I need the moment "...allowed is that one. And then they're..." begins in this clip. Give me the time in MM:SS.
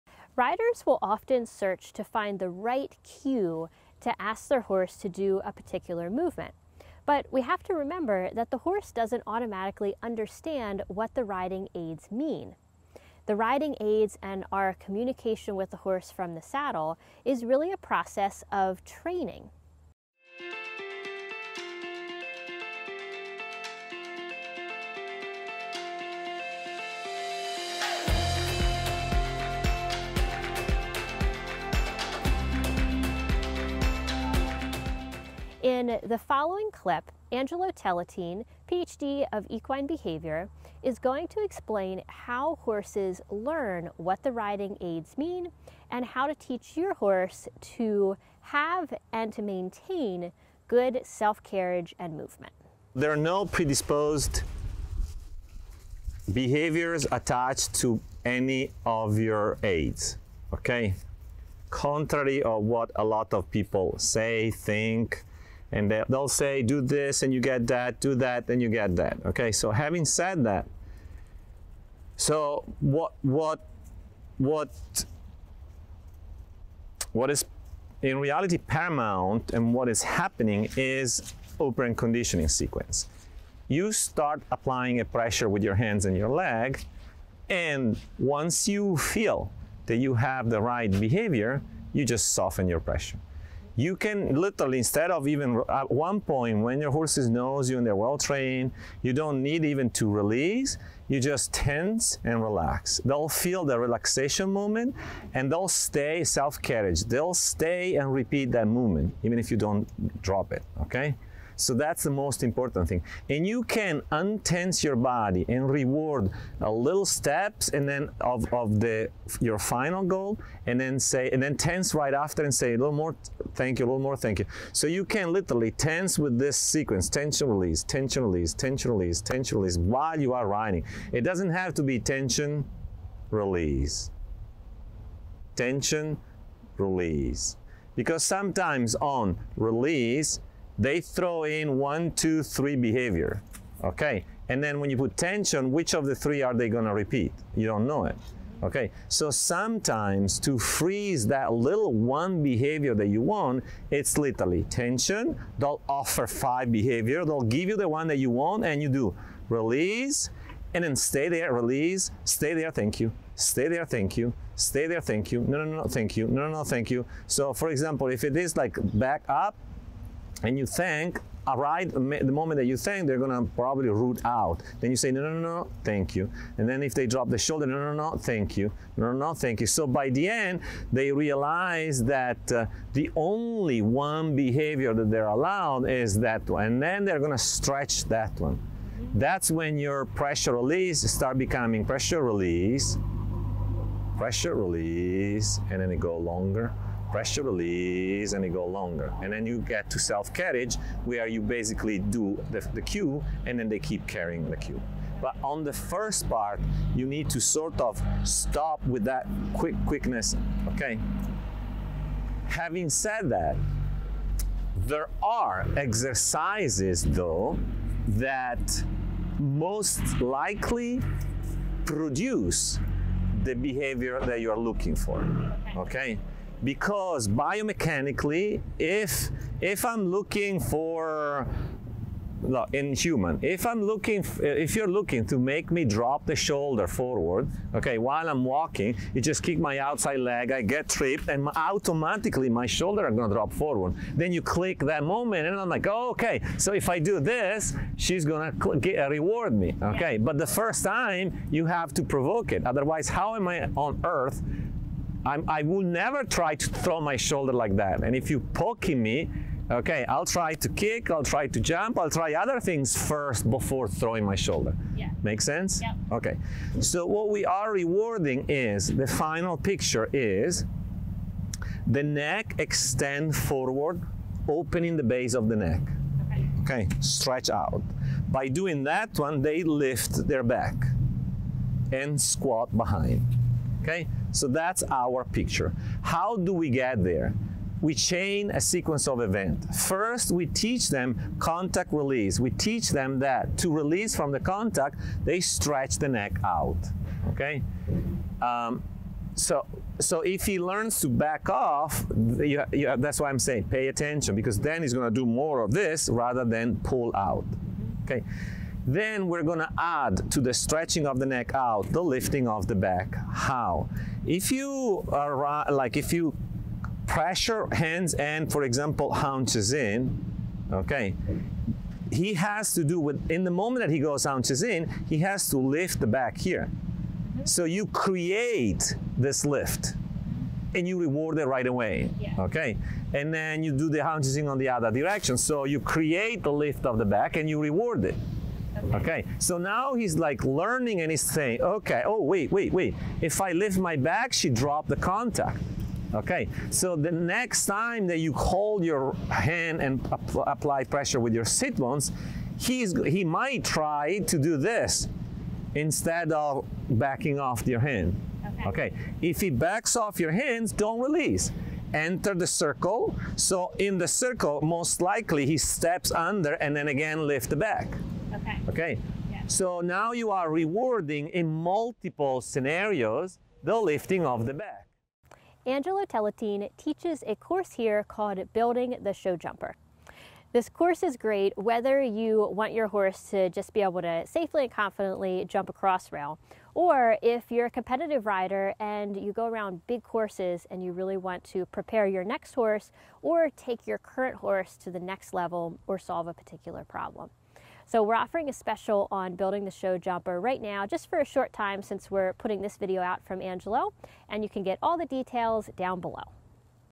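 03:05.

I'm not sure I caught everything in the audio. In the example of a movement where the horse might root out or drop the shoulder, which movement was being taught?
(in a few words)
Back up.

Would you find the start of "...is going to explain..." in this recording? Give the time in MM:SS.
00:40.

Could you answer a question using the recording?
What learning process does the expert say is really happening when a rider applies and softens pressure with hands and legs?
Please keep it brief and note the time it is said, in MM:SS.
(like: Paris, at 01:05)
Operant conditioning, at 01:21.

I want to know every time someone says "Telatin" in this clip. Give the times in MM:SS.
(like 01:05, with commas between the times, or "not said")
00:37, 06:16.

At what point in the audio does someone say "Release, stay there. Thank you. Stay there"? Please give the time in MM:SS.
02:41.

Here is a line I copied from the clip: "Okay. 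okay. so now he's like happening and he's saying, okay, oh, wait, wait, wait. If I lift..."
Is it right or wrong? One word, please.
wrong.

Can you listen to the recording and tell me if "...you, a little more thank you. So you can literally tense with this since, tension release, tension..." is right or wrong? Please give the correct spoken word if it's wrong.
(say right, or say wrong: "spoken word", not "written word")
wrong: "sequence", not "since".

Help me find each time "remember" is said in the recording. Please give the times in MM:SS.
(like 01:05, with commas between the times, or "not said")
00:07.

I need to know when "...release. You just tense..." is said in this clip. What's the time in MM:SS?
01:40.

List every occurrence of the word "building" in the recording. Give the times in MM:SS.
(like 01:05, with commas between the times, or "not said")
06:18, 06:39.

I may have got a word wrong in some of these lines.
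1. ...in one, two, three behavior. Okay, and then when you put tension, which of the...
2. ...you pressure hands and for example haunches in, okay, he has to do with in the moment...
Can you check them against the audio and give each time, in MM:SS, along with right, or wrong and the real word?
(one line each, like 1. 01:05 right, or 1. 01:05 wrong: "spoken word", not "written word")
1. 02:21 right
2. 05:16 right.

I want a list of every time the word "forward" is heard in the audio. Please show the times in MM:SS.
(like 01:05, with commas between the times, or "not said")
03:56, 04:03, 04:33.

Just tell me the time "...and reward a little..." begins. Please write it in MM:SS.
01:55.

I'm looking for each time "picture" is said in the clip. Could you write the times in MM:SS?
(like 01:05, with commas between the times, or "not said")
04:29, 04:45.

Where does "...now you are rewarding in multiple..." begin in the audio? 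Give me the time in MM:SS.
06:09.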